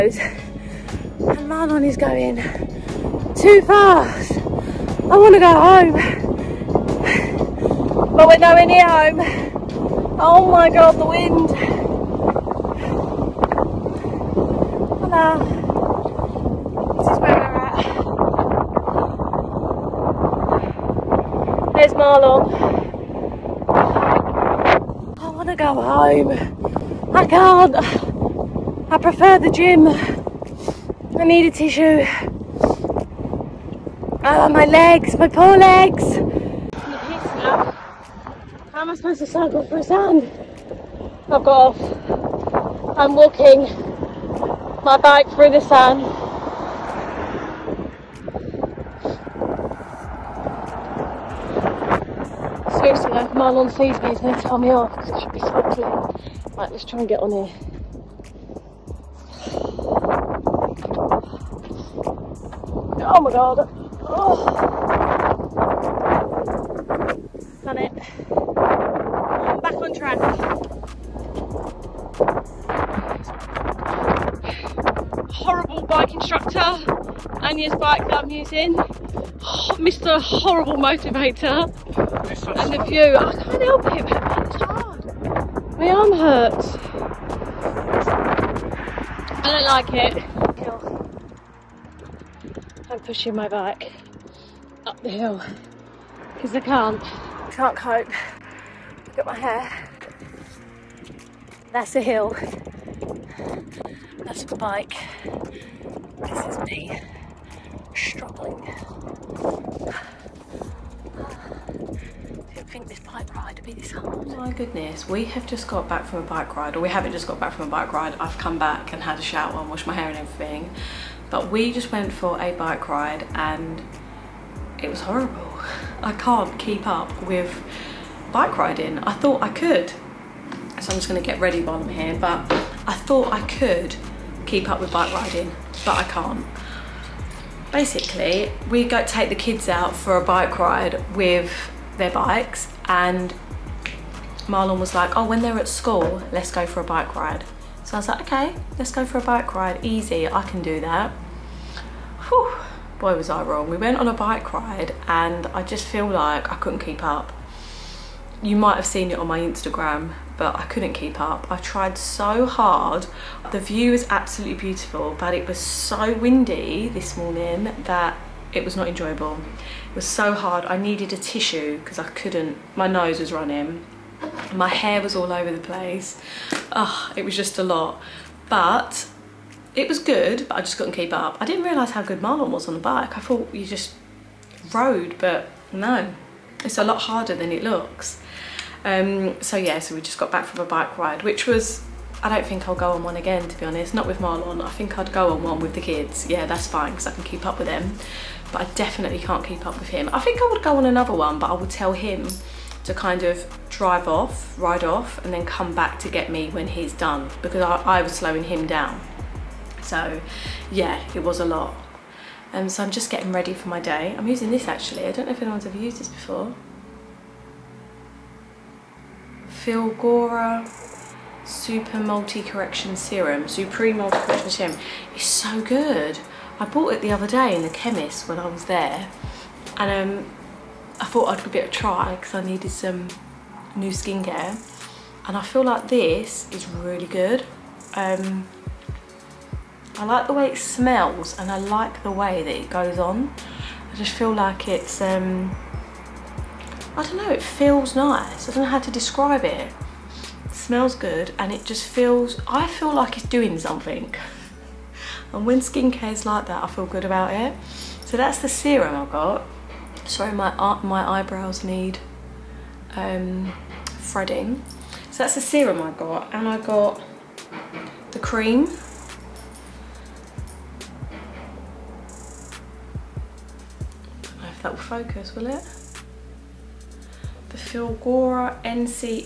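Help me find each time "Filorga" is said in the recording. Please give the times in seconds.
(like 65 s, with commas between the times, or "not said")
219 s, 277 s.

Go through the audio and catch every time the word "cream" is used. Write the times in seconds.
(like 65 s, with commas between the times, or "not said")
268 s.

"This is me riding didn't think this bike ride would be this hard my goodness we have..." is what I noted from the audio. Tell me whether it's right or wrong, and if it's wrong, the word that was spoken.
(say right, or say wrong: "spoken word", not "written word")
wrong: "struggling", not "riding".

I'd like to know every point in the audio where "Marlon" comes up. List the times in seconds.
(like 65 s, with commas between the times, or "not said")
1 s, 144 s, 182 s, 194 s.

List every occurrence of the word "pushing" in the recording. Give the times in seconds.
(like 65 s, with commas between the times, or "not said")
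93 s.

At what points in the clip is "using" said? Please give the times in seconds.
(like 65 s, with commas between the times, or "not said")
78 s, 214 s.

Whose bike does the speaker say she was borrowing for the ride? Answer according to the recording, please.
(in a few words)
Anya's.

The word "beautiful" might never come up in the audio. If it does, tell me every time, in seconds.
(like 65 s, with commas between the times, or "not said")
164 s.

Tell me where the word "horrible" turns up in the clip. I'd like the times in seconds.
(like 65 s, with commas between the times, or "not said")
75 s, 80 s, 125 s.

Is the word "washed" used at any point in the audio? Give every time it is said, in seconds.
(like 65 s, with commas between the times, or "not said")
119 s.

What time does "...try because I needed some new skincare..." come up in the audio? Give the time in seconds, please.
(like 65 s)
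231 s.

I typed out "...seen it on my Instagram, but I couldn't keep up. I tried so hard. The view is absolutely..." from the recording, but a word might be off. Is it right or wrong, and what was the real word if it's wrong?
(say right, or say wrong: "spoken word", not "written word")
right.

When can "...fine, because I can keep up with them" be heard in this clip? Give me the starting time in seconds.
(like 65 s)
196 s.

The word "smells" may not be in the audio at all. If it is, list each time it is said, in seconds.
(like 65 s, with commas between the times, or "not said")
240 s, 250 s.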